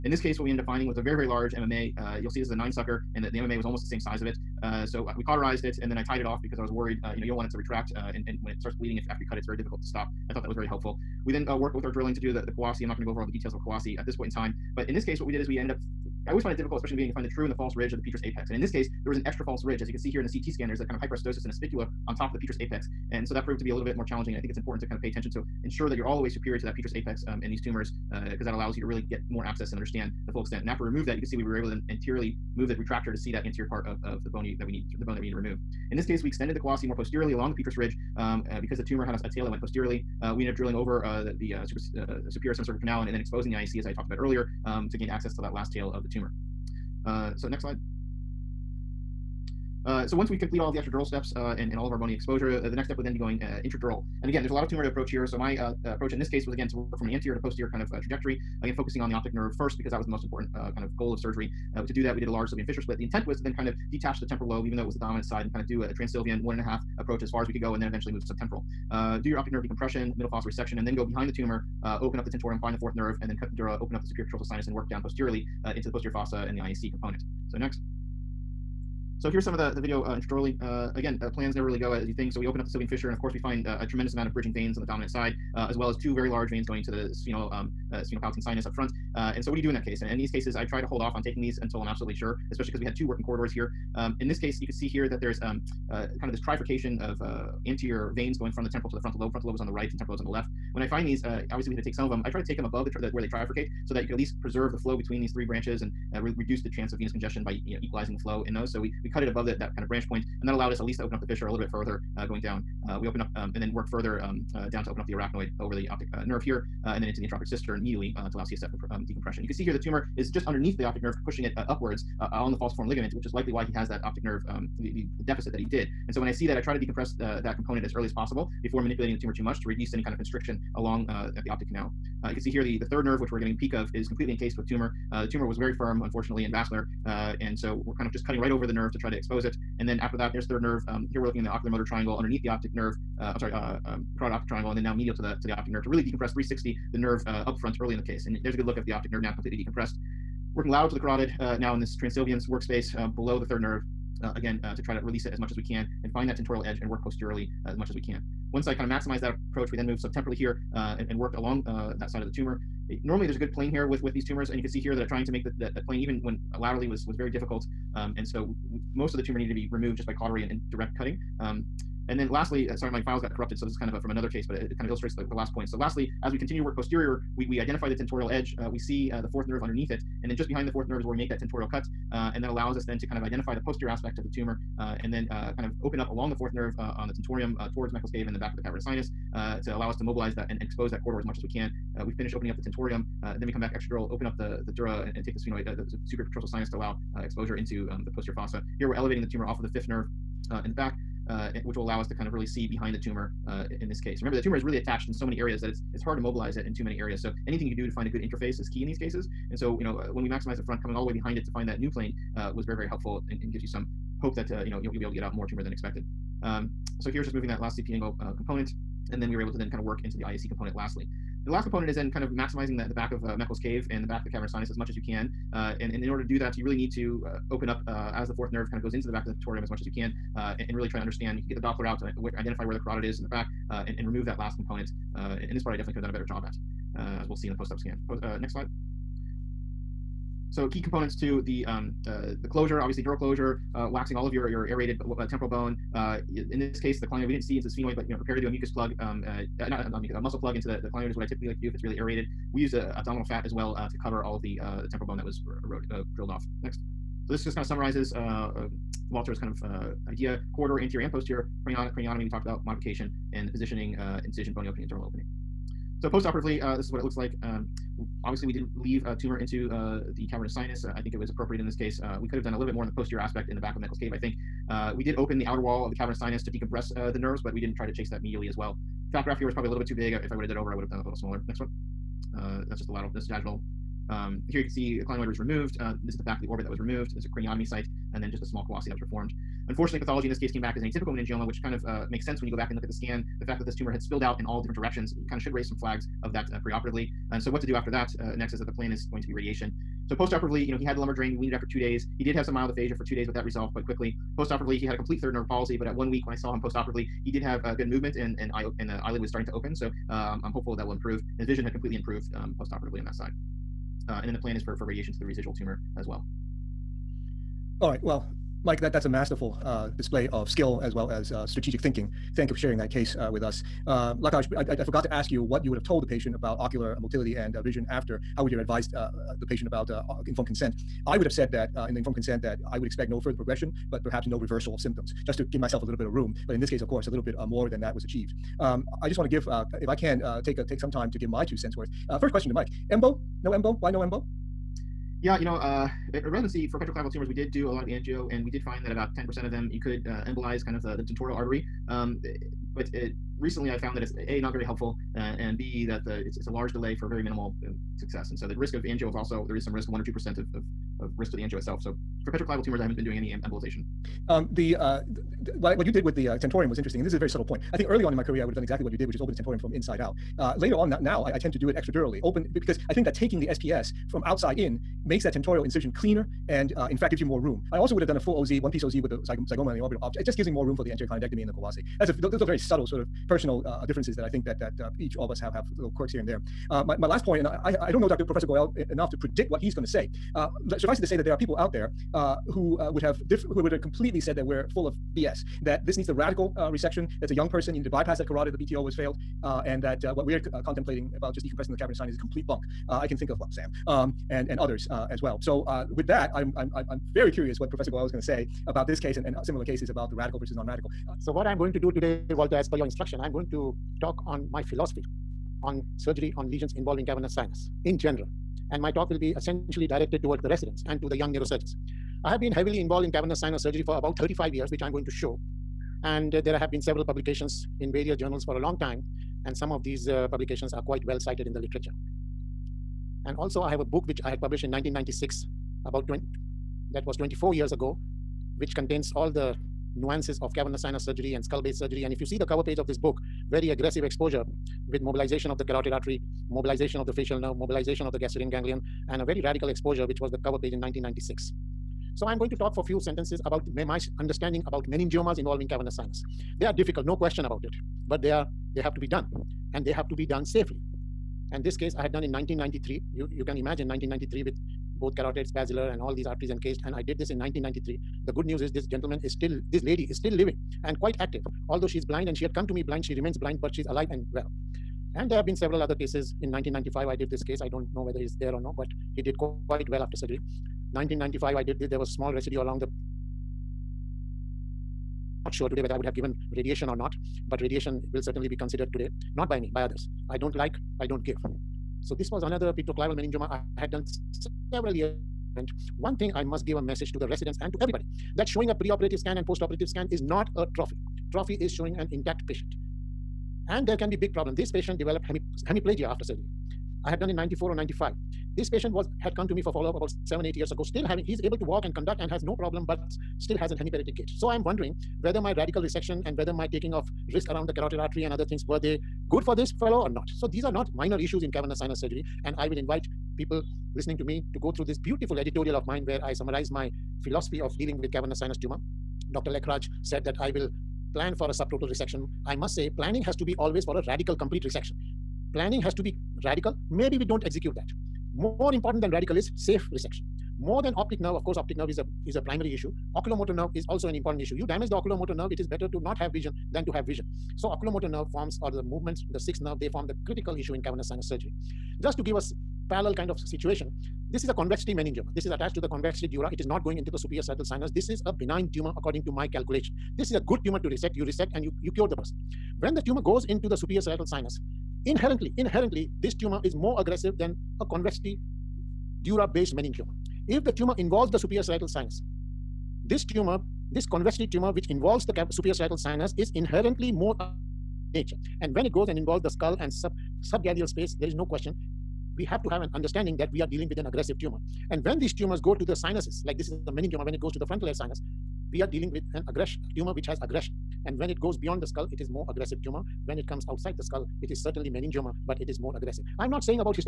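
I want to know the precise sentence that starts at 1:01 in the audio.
Uh, to do that, we did a large Sylvian fissure split.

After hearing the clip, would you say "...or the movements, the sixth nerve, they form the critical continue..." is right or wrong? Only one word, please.
wrong.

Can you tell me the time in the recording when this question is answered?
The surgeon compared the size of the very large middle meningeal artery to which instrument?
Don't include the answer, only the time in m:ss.
0:02.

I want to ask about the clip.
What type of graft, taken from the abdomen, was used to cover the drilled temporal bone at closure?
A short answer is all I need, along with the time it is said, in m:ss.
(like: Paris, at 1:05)
abdominal fat, at 4:12.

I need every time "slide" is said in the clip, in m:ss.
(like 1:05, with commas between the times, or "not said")
0:47, 3:58.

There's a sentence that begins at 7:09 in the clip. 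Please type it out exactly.
And some of these uh, publications are quite well cited in the literature.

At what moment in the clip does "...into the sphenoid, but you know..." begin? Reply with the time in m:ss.
4:07.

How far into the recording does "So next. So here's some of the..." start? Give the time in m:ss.
1:17.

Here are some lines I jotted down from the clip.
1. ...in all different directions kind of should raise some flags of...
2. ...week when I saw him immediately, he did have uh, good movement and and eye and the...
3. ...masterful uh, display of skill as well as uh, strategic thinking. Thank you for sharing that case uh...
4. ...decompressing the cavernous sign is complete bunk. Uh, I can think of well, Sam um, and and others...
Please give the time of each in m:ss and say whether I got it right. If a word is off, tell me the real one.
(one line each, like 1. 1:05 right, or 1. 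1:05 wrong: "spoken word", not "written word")
1. 4:54 right
2. 5:06 wrong: "postoperatively", not "immediately"
3. 5:19 right
4. 6:41 right.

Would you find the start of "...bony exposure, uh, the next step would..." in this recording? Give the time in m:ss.
0:51.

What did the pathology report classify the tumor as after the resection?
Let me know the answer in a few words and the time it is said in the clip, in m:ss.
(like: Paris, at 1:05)
atypical meningioma, at 4:50.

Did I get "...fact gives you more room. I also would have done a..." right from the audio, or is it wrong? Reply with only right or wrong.
right.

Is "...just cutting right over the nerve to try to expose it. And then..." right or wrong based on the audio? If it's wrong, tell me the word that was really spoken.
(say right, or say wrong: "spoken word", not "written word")
right.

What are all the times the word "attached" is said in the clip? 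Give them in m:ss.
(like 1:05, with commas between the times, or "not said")
3:24, 9:15.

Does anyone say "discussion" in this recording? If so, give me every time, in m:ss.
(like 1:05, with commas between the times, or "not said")
not said.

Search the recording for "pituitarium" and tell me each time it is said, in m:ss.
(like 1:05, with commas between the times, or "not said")
3:49.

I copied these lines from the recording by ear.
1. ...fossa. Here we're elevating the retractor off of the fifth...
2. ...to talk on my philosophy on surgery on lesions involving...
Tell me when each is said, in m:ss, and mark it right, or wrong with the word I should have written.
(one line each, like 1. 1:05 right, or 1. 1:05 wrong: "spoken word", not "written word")
1. 3:18 wrong: "tumor", not "retractor"
2. 6:53 right.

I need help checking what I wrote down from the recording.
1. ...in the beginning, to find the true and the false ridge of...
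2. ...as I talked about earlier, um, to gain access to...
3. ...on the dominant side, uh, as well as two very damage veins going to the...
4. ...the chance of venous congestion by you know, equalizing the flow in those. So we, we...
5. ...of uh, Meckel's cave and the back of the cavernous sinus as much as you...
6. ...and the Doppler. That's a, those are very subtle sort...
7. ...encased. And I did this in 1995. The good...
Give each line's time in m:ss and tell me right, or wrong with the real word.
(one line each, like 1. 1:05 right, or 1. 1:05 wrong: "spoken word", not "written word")
1. 0:16 right
2. 0:43 right
3. 1:24 wrong: "large", not "damage"
4. 1:46 right
5. 3:43 right
6. 6:21 wrong: "Kawase", not "Doppler"
7. 7:46 wrong: "1993", not "1995".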